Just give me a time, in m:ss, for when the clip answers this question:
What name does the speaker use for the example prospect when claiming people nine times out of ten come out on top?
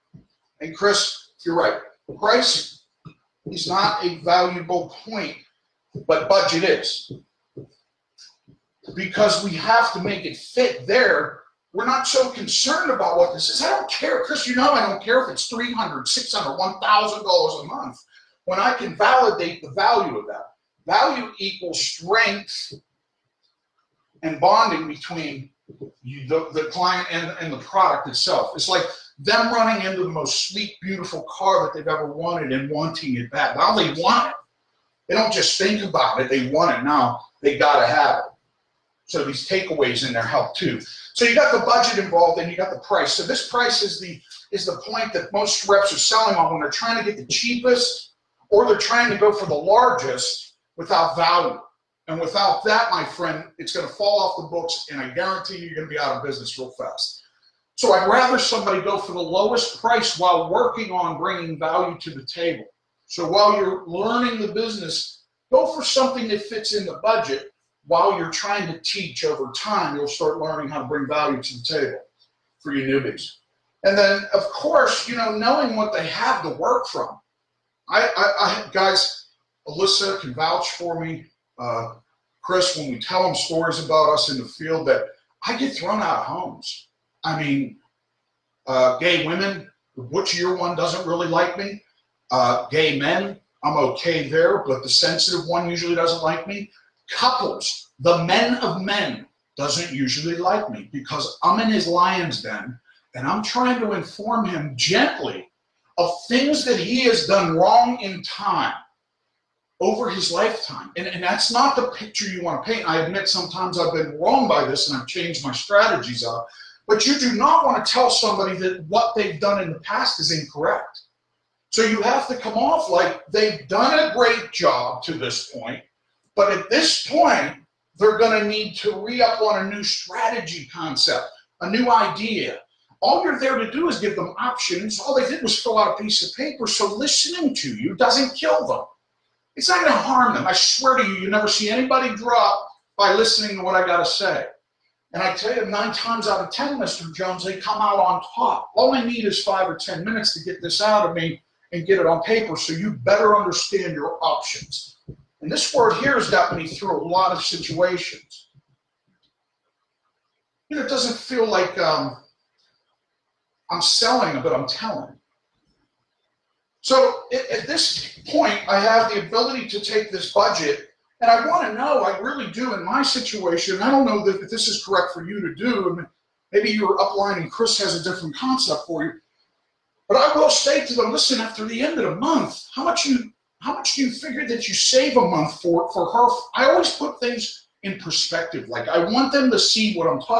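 2:26.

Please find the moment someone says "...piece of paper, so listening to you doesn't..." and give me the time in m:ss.
2:16.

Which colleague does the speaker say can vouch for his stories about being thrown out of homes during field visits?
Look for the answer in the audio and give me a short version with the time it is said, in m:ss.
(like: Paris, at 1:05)
Alyssa, at 1:19.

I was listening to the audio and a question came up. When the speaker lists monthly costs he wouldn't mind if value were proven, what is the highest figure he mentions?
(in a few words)
$1,000.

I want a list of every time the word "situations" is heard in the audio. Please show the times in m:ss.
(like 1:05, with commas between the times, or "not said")
2:37, 2:53.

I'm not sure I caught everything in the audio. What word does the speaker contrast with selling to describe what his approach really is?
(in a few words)
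telling.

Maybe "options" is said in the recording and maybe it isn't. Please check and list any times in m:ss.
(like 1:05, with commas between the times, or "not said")
2:14, 2:34.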